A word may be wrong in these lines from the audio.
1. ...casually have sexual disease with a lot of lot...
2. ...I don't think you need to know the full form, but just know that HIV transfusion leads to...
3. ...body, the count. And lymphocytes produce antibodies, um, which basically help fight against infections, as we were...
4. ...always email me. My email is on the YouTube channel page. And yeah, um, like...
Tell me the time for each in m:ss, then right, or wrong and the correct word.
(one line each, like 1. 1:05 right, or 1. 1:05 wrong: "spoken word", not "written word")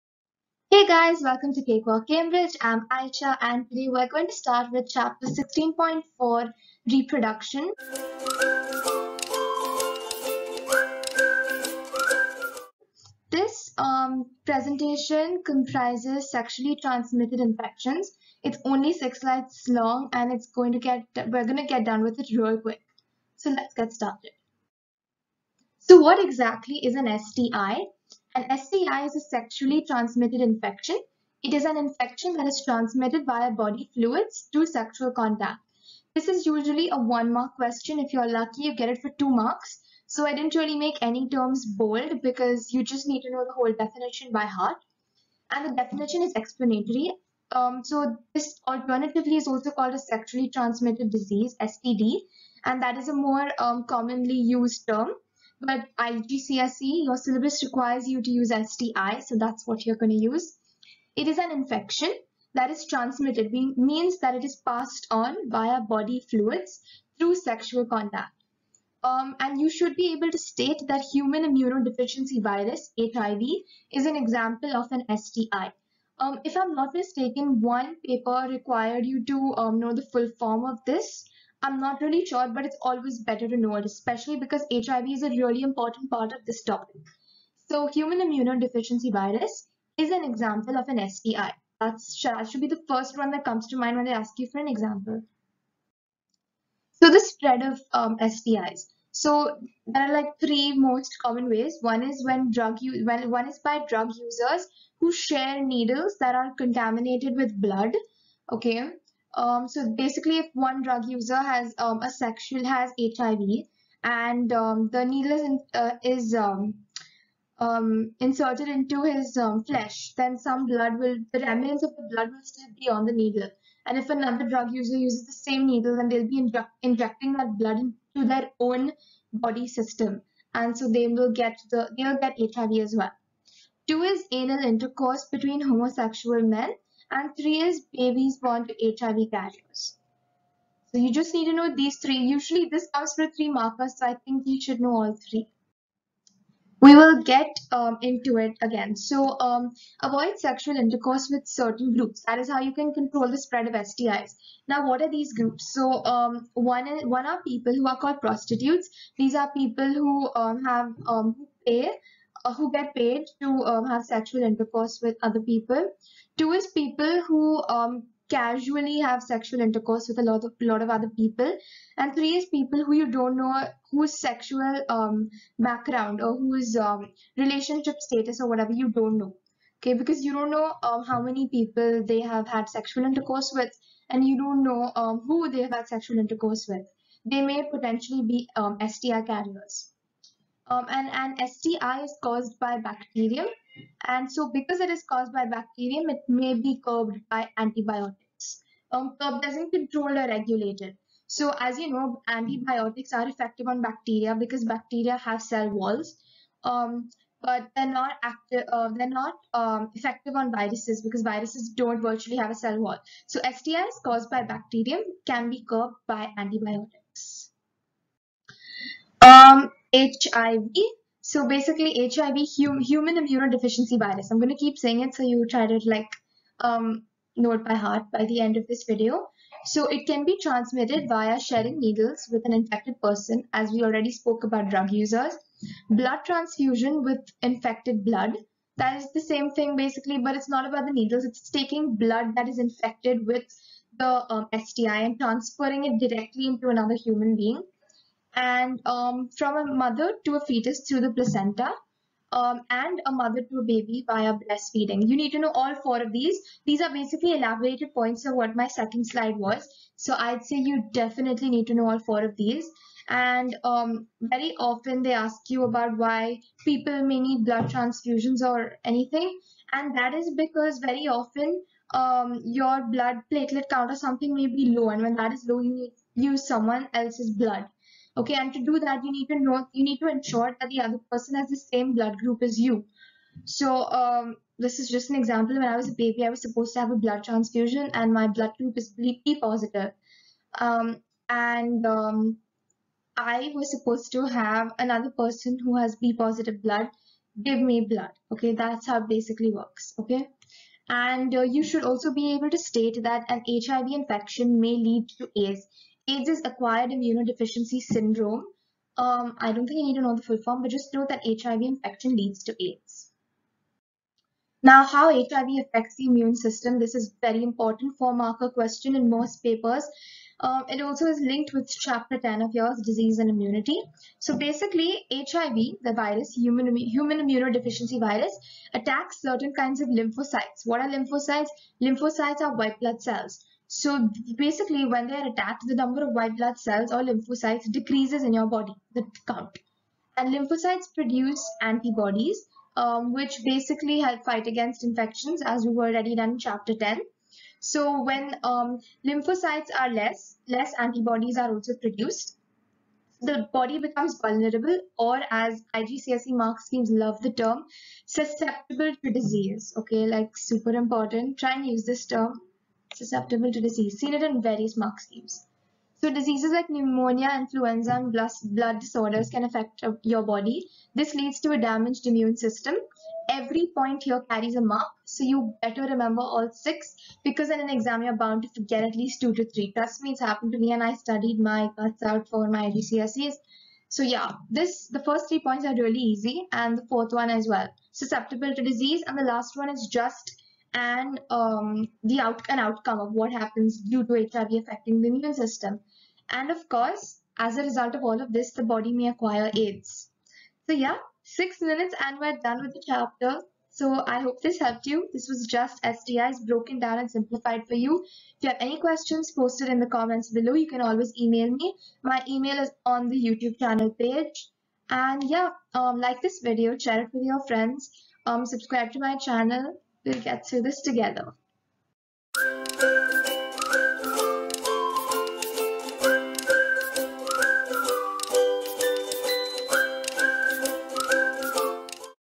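1. 2:48 wrong: "intercourse", not "disease"
2. 5:09 wrong: "infection", not "transfusion"
3. 5:38 right
4. 6:50 right.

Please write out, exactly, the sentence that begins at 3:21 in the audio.
So as you know, antibiotics are effective on bacteria because bacteria have cell walls.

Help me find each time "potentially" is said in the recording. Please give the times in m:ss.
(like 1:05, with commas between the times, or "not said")
3:07.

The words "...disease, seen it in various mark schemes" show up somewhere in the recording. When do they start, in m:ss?
6:03.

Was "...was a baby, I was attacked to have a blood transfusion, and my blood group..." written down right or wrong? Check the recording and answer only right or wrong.
wrong.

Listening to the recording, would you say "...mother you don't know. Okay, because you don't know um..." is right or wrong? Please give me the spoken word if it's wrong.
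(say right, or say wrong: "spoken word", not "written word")
wrong: "whatever", not "mother".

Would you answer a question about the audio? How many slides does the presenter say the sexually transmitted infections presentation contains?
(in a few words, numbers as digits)
6.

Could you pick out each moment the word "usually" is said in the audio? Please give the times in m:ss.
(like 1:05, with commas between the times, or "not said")
0:36, 2:22.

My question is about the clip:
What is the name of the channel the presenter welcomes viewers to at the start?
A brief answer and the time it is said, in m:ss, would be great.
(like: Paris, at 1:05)
Cakewalk Cambridge, at 0:01.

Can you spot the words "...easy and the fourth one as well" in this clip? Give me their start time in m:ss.
6:25.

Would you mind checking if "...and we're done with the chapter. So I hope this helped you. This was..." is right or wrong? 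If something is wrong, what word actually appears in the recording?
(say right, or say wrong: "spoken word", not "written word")
right.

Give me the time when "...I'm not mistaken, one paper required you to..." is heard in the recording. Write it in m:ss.
1:16.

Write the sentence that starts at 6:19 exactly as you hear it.
Trust me, it's happened to me and I studied my guts out for my GCSEs.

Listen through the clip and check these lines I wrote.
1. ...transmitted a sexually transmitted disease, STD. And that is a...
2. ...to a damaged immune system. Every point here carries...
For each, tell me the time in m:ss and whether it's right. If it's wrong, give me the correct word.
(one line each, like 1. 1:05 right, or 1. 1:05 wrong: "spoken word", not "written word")
1. 0:49 wrong: "called", not "transmitted"
2. 6:11 right.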